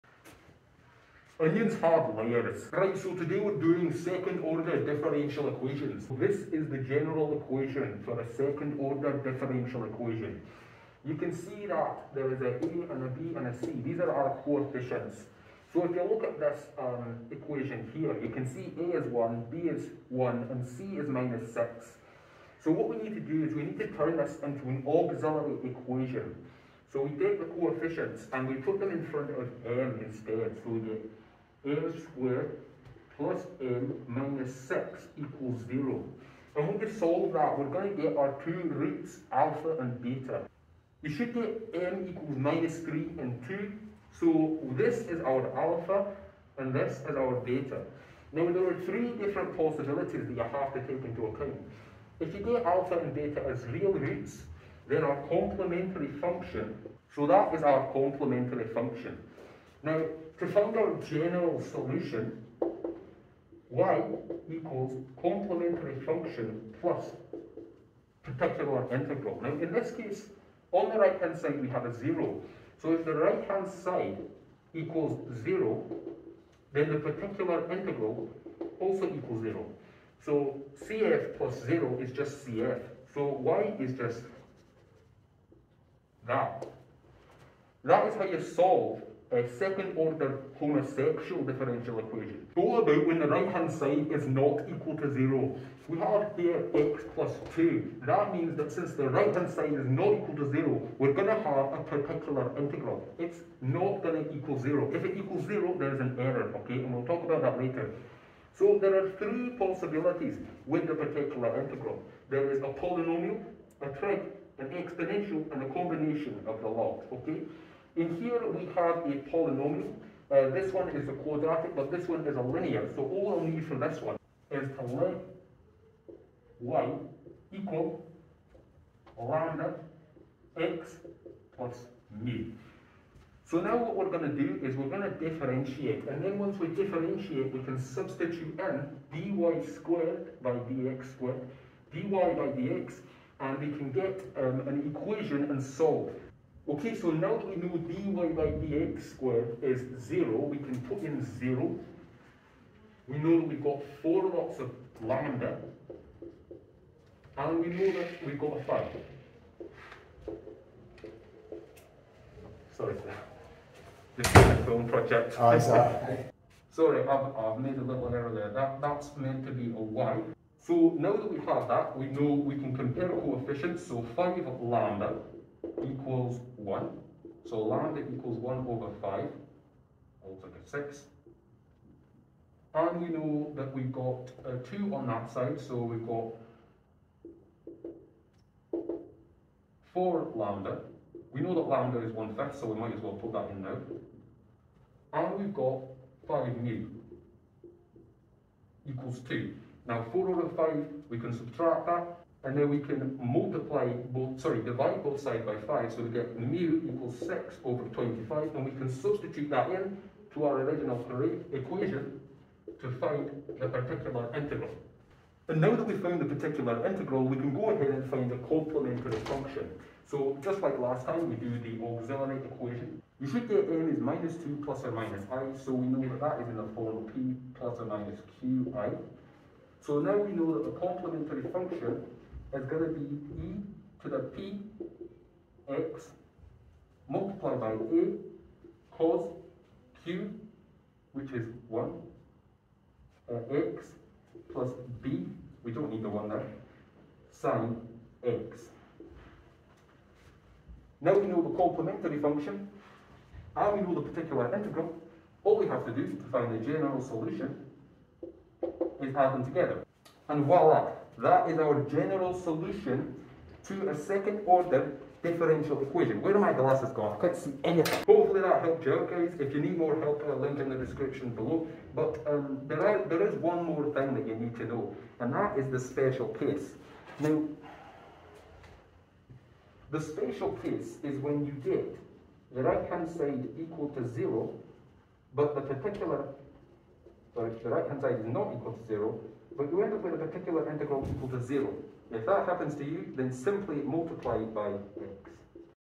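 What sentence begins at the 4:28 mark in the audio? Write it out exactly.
Hopefully that helped you out guys.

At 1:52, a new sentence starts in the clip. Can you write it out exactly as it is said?
There is a polynomial, a trig, an exponential, and a combination of the lot, okay?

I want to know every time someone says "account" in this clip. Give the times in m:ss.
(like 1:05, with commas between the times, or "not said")
0:51.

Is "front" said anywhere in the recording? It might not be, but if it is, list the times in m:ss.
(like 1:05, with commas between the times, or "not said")
0:29.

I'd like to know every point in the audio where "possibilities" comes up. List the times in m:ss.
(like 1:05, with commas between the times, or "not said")
0:49, 1:49.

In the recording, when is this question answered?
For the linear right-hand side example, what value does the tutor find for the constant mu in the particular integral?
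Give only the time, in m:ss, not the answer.
3:27.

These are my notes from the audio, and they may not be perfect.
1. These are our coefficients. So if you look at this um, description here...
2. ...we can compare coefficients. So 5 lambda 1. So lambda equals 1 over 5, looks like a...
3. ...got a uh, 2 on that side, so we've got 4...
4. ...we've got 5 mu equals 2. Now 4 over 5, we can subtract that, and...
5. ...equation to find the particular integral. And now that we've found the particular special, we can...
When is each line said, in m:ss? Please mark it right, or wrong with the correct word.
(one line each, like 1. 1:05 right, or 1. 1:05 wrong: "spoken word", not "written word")
1. 0:13 wrong: "equation", not "description"
2. 2:52 right
3. 3:03 right
4. 3:15 right
5. 3:31 wrong: "integral", not "special".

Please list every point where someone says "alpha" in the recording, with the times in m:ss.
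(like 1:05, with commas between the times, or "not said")
0:39, 0:45, 0:52.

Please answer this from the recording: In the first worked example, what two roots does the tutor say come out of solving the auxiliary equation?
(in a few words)
-3 and 2.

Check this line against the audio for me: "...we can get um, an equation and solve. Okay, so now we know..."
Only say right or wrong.
right.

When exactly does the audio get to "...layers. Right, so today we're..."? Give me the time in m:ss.
0:02.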